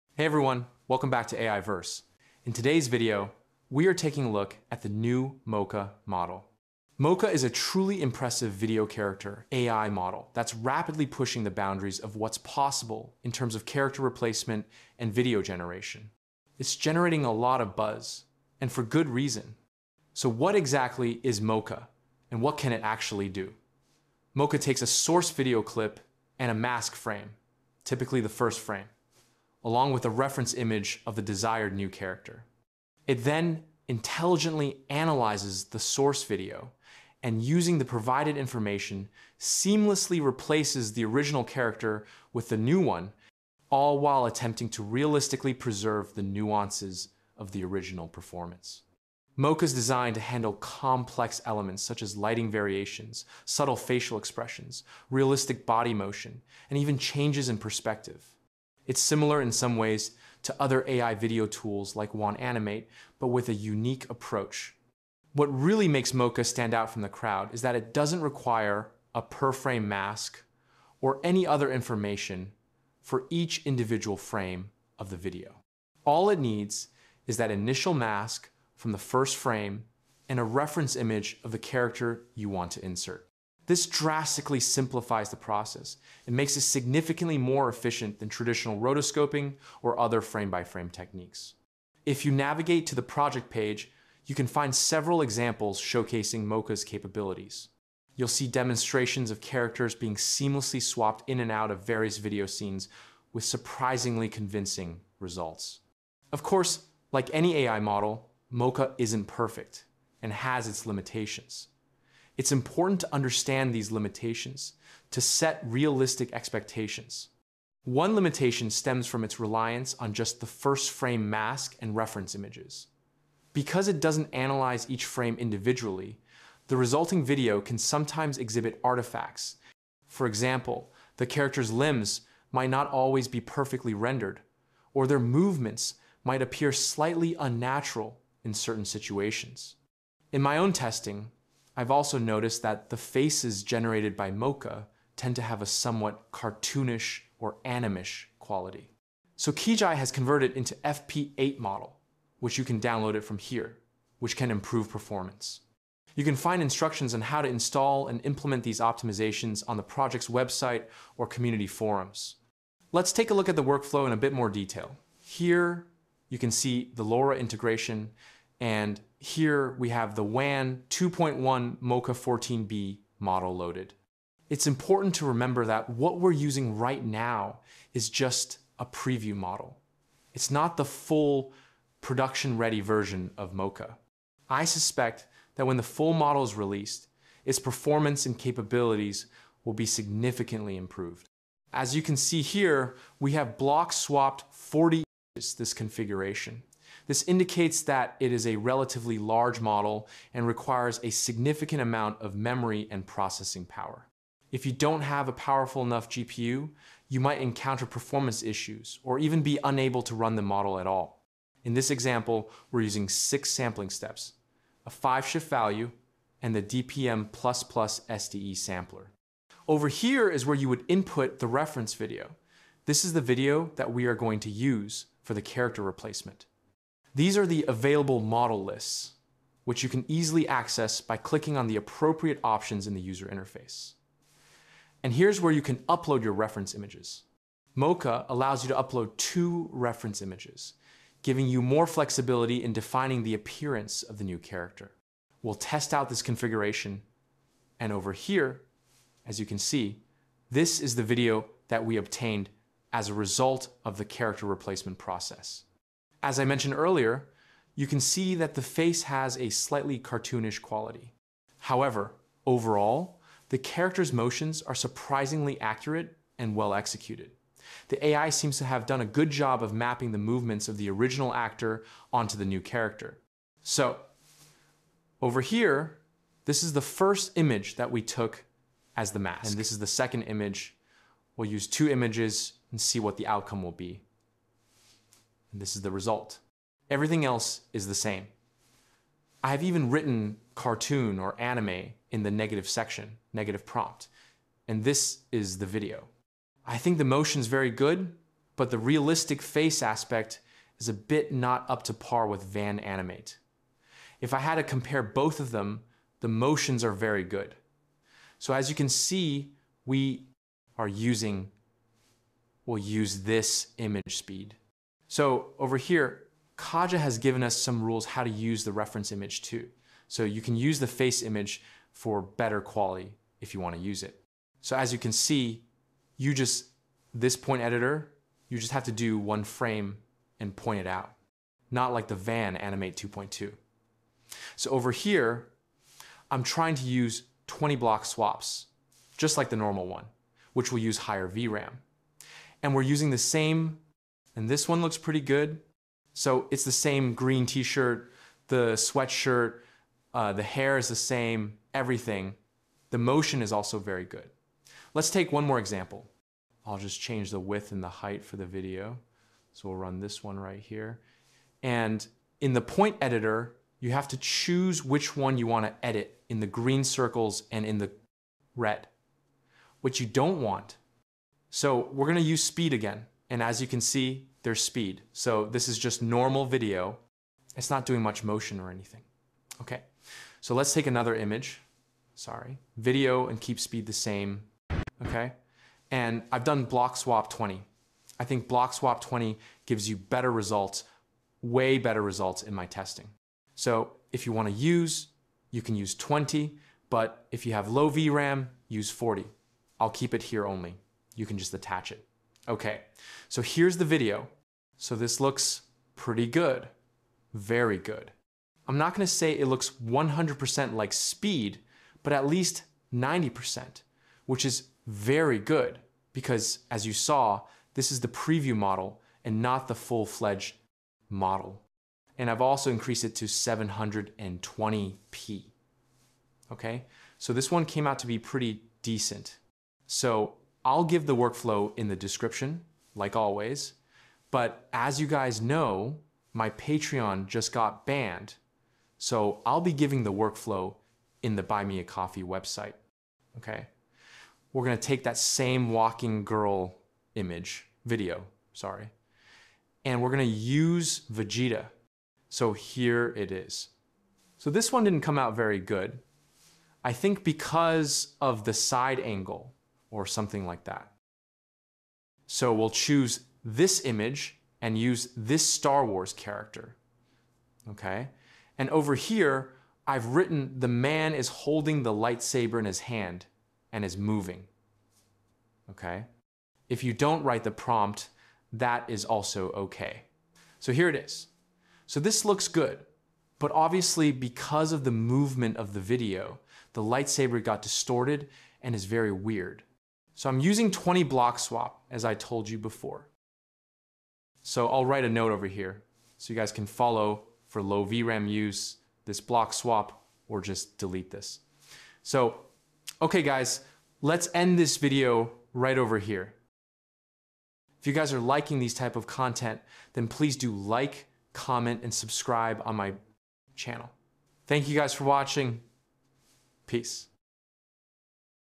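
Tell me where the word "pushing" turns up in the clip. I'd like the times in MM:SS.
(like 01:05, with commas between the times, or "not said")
00:11.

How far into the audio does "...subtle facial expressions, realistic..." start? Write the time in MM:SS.
00:53.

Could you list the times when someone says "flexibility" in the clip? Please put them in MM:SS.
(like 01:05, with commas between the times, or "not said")
04:01.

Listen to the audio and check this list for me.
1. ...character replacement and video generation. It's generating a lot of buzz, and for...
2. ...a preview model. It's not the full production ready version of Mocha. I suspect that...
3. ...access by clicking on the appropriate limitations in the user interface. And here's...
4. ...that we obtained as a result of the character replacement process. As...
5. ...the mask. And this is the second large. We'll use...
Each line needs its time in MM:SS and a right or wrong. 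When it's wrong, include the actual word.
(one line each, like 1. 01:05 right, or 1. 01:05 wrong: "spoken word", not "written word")
1. 00:13 right
2. 02:58 right
3. 03:50 wrong: "options", not "limitations"
4. 04:11 right
5. 04:39 wrong: "image", not "large".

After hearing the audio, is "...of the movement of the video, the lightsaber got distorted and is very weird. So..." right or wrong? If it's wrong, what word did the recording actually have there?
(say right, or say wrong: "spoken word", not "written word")
right.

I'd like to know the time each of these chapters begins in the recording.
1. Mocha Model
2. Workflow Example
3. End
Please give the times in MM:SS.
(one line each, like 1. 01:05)
1. 00:10
2. 02:36
3. 08:15.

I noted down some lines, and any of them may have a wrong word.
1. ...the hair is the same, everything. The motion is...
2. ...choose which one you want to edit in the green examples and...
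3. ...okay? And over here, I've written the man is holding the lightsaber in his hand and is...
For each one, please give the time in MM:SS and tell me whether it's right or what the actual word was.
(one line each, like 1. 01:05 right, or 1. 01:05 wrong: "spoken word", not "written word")
1. 05:50 right
2. 06:04 wrong: "circles", not "examples"
3. 07:47 right.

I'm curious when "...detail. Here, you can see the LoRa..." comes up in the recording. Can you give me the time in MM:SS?
02:44.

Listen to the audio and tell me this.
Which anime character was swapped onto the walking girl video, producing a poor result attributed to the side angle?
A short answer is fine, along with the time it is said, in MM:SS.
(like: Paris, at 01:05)
Vegeta, at 07:31.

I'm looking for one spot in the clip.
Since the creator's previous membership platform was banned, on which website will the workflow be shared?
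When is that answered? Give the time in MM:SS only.
07:21.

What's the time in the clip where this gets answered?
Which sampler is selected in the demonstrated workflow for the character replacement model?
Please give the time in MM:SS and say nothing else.
03:36.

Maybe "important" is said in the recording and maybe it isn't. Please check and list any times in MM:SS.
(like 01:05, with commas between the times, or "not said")
01:52, 02:54.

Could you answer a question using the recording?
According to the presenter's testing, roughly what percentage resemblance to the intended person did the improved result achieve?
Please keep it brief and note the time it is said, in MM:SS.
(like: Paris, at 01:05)
90%, at 06:52.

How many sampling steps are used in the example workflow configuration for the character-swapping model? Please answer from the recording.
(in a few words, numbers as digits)
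6.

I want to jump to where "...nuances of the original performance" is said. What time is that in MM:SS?
00:46.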